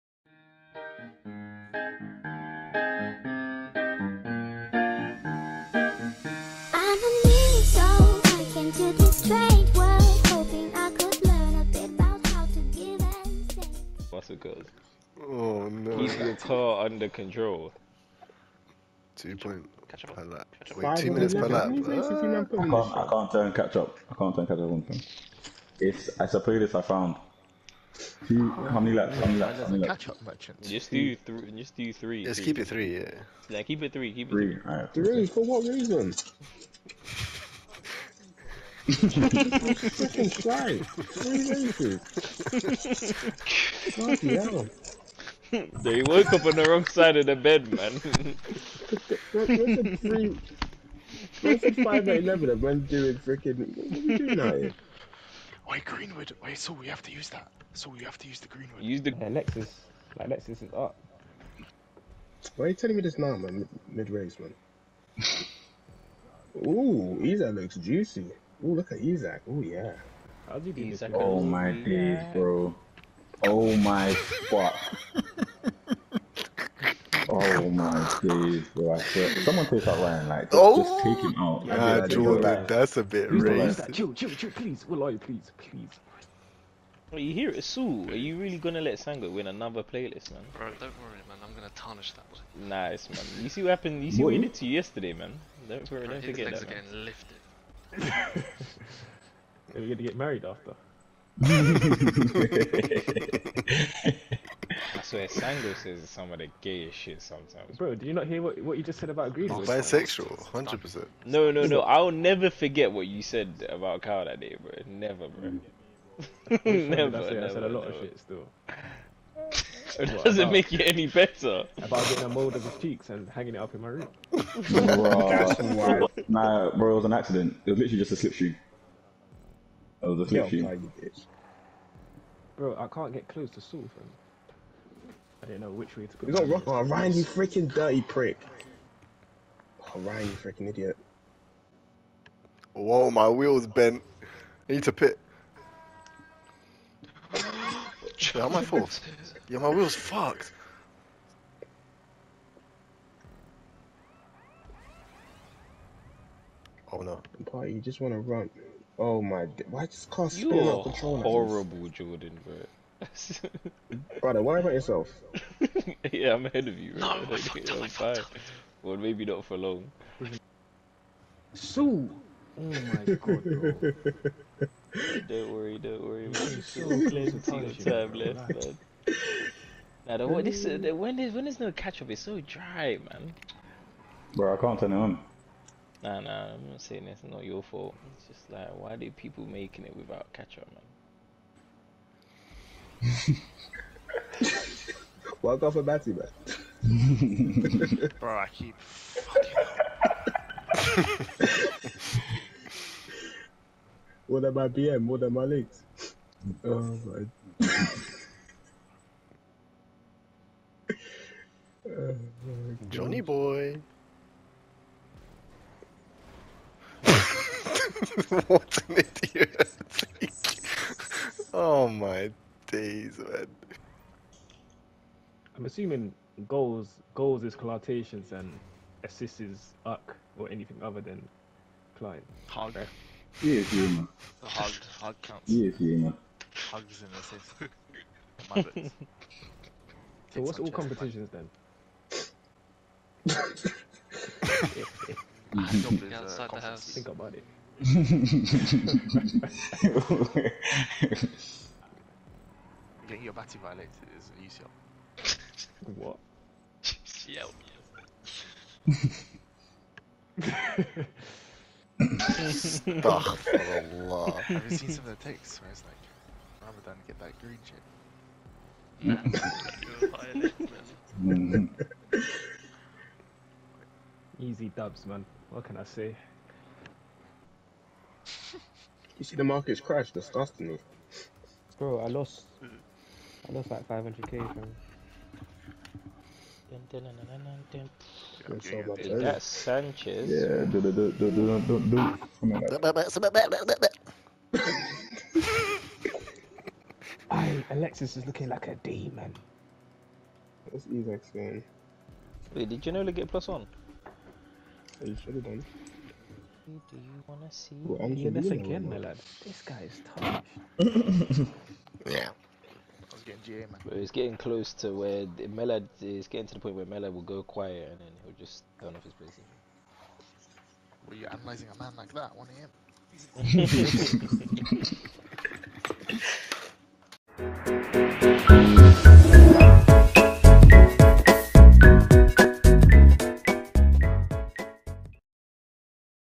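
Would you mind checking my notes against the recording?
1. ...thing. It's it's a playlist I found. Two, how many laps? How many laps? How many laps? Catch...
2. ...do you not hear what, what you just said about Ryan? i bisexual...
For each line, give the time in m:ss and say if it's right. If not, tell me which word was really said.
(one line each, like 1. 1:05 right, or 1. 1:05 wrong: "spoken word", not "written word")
1. 0:24 right
2. 1:47 wrong: "Greece", not "Ryan".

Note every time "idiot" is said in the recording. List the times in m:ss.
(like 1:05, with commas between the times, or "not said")
2:20, 3:39.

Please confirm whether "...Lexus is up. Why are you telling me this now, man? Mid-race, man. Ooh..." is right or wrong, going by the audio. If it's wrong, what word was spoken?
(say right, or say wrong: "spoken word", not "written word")
right.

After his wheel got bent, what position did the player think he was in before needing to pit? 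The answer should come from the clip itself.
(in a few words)
Fourth.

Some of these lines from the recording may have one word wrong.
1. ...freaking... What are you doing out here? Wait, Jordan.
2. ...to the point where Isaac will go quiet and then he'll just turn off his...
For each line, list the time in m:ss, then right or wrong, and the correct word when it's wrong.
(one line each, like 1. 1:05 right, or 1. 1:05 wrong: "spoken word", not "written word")
1. 0:53 wrong: "Greenwood", not "Jordan"
2. 5:16 wrong: "Melad", not "Isaac".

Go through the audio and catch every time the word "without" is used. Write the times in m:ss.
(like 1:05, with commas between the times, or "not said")
3:09.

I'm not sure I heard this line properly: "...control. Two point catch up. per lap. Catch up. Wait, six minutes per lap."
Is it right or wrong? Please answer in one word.
wrong.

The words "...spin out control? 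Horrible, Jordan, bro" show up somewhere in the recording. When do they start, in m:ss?
2:40.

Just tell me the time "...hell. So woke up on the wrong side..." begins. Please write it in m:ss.
0:44.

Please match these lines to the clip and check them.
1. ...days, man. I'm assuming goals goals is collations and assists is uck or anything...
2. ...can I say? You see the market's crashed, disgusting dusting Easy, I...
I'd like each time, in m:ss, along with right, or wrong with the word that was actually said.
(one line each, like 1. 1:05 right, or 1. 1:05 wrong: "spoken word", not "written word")
1. 3:42 right
2. 4:35 wrong: "Bro", not "Easy".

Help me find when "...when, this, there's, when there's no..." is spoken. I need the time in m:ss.
3:00.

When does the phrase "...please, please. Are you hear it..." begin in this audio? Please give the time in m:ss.
1:25.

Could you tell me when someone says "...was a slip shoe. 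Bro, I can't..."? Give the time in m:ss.
2:10.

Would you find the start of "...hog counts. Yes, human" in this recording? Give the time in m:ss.
3:54.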